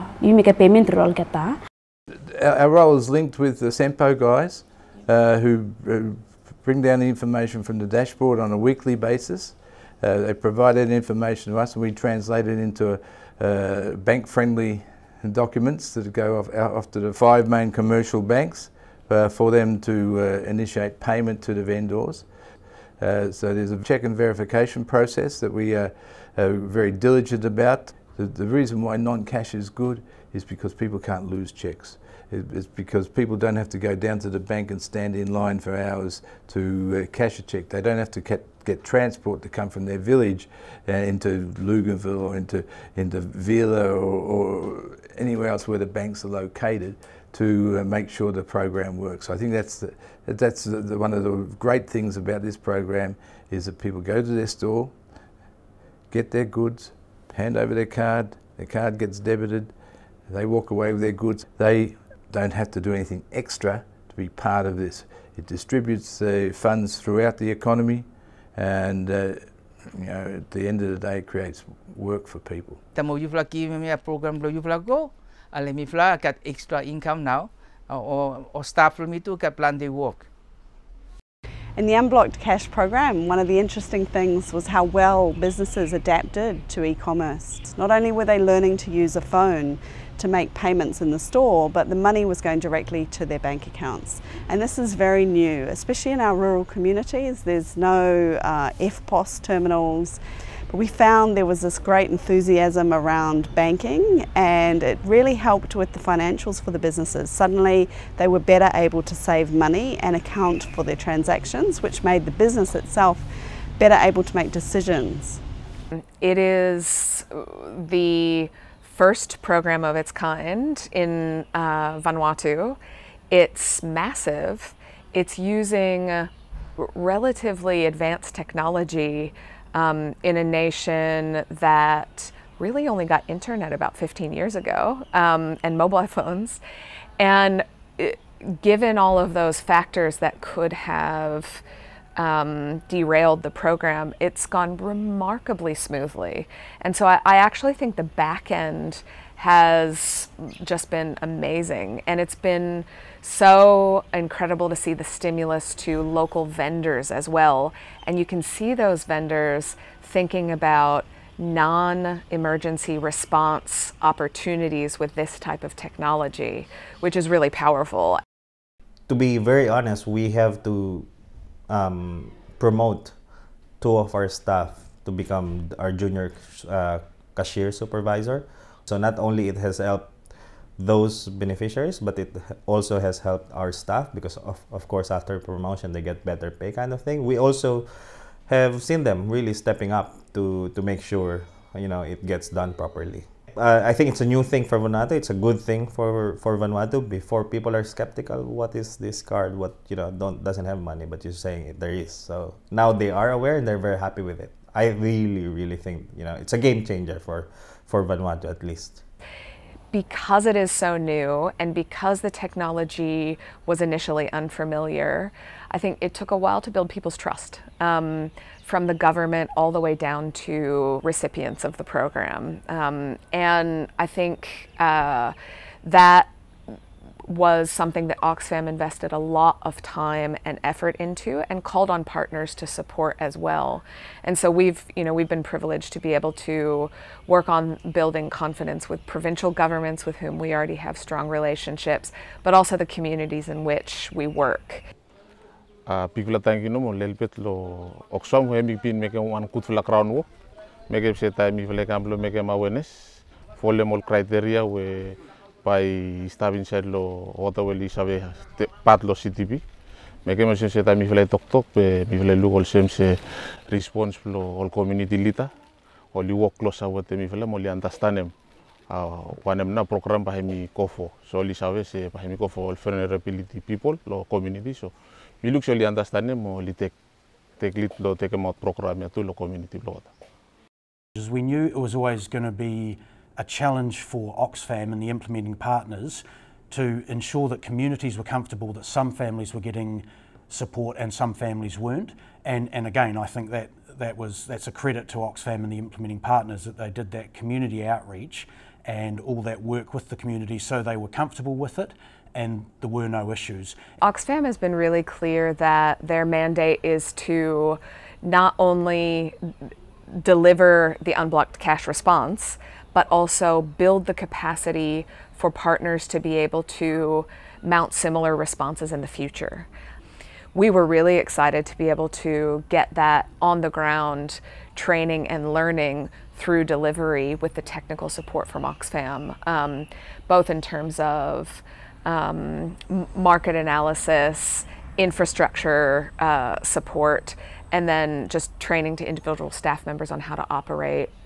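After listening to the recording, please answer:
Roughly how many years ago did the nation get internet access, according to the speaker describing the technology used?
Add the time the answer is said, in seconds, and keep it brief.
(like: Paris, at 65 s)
15 years, at 133 s.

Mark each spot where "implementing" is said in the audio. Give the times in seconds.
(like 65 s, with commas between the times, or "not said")
285 s, 295 s.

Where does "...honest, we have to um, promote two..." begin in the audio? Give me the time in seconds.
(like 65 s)
169 s.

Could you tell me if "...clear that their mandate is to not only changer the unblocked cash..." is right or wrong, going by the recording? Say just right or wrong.
wrong.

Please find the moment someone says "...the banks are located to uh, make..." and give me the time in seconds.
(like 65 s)
45 s.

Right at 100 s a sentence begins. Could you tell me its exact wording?
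But we found there was this great enthusiasm around banking, and it really helped with the financials for the businesses.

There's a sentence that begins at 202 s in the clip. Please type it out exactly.
So now they are aware and they're very happy with it.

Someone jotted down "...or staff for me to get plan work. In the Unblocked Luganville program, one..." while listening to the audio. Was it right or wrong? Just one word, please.
wrong.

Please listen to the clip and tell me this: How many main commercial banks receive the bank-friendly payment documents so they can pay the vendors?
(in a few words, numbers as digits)
5.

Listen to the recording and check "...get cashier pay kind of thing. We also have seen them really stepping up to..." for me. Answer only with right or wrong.
wrong.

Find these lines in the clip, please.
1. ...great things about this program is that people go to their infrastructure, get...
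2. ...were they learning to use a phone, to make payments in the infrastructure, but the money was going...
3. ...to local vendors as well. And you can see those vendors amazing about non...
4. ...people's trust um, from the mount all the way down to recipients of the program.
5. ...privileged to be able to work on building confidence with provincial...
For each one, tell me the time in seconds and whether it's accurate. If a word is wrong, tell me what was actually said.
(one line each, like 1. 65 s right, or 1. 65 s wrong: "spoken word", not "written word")
1. 51 s wrong: "store", not "infrastructure"
2. 88 s wrong: "store", not "infrastructure"
3. 155 s wrong: "thinking", not "amazing"
4. 216 s wrong: "government", not "mount"
5. 235 s right.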